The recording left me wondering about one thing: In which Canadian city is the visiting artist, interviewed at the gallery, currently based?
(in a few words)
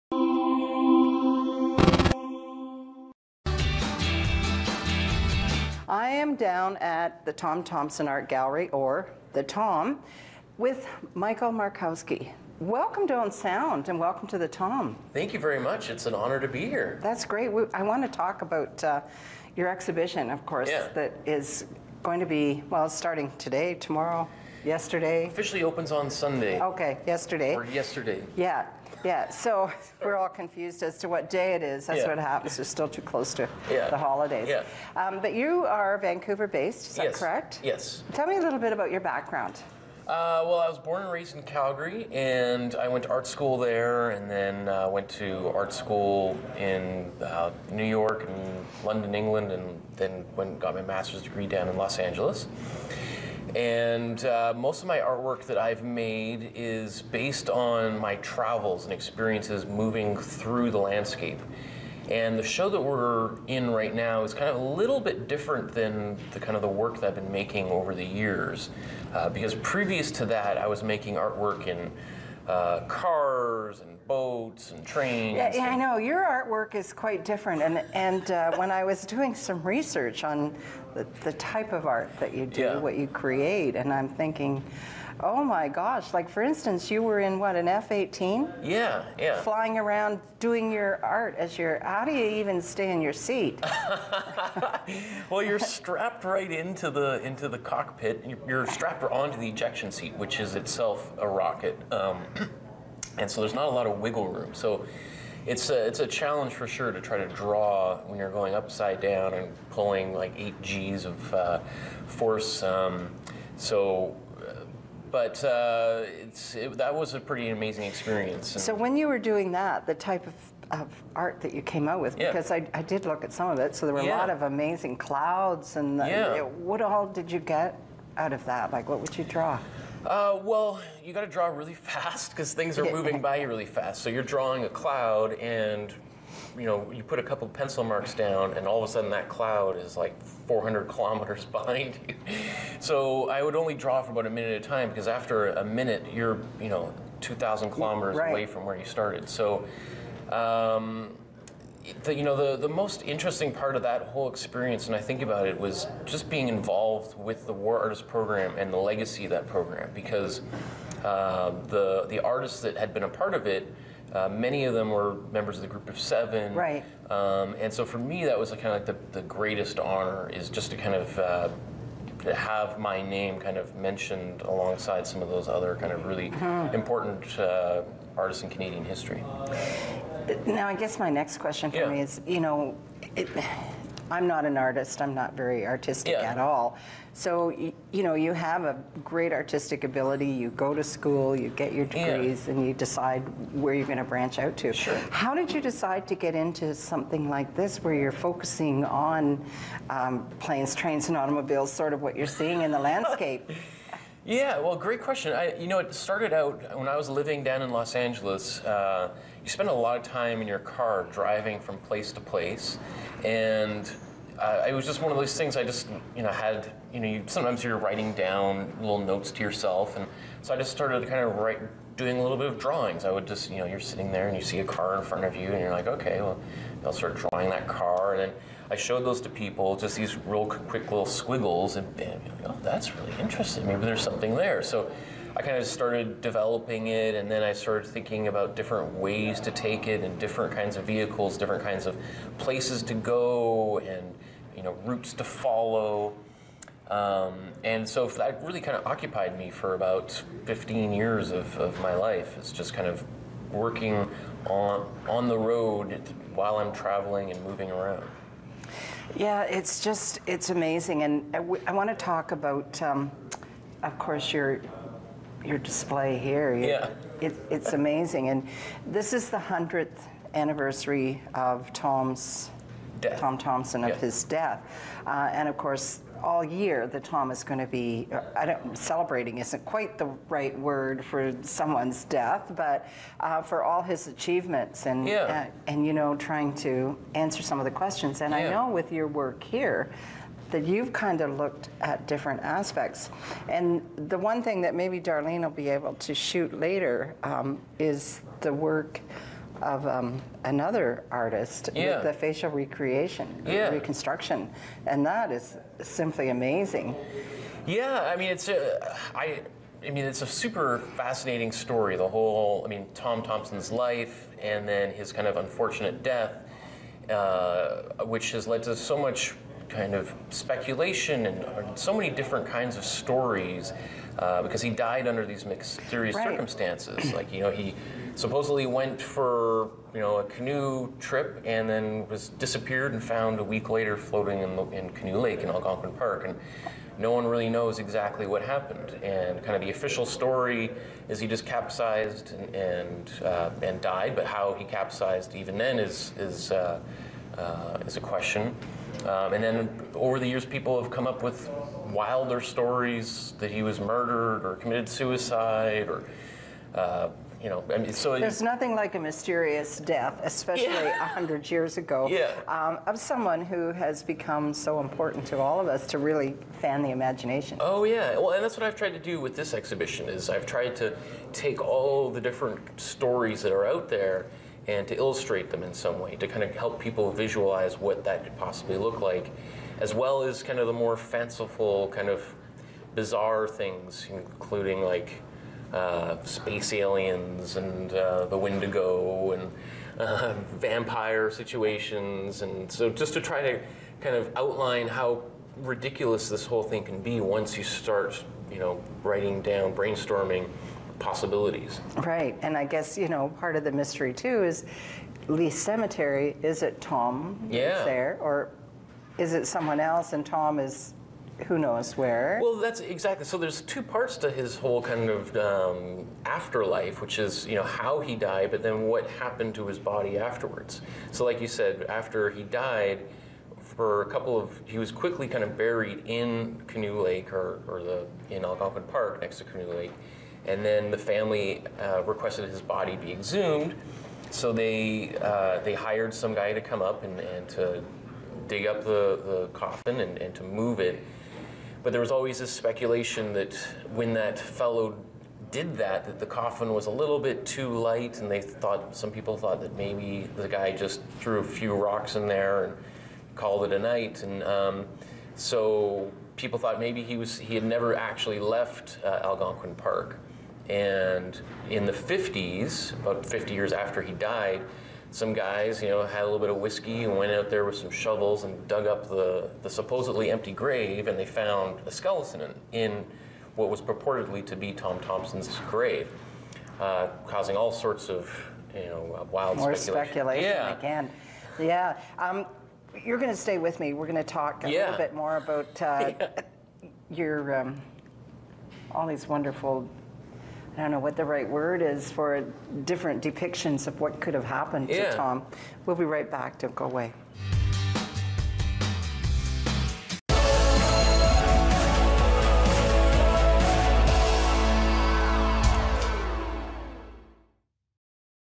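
Vancouver.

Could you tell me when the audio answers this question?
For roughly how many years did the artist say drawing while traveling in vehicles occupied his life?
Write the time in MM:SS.
04:10.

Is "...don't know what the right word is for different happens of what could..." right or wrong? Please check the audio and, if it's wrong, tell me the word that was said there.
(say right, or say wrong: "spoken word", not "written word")
wrong: "depictions", not "happens".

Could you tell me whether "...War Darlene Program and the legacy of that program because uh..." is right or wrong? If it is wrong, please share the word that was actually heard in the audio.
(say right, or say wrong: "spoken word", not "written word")
wrong: "Artist", not "Darlene".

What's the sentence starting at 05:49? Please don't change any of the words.
Um, and then over the years, people have come up with wilder stories that he was murdered or committed suicide or.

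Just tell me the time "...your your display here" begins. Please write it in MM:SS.
04:24.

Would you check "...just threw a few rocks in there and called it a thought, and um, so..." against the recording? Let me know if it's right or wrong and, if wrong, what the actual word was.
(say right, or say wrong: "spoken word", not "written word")
wrong: "night", not "thought".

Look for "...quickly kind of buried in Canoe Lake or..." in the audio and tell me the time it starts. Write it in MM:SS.
07:04.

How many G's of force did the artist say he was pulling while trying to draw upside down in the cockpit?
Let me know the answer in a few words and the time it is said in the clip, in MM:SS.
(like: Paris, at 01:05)
8, at 01:50.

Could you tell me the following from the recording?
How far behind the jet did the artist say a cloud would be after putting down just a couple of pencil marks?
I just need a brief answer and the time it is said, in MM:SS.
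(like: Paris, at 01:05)
400 kilometers, at 02:20.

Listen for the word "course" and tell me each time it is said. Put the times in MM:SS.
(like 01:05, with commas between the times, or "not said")
00:20, 04:23, 04:35.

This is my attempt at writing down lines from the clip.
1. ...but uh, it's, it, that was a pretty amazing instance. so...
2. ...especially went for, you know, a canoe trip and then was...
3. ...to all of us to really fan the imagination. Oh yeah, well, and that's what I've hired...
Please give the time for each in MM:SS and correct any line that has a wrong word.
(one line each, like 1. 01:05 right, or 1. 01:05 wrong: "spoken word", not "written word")
1. 01:55 wrong: "experience", not "instance"
2. 05:28 wrong: "supposedly", not "especially"
3. 06:05 wrong: "tried", not "hired".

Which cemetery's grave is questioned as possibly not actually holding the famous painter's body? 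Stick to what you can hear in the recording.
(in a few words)
Leith Cemetery.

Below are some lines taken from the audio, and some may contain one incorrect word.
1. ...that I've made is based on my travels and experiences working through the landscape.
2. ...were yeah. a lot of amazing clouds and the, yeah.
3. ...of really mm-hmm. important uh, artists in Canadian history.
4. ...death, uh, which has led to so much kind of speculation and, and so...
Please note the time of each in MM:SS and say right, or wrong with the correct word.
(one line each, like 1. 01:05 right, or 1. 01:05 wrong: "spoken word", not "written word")
1. 00:55 wrong: "moving", not "working"
2. 02:03 right
3. 02:55 right
4. 05:16 right.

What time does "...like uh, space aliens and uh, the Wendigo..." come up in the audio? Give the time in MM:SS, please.
06:24.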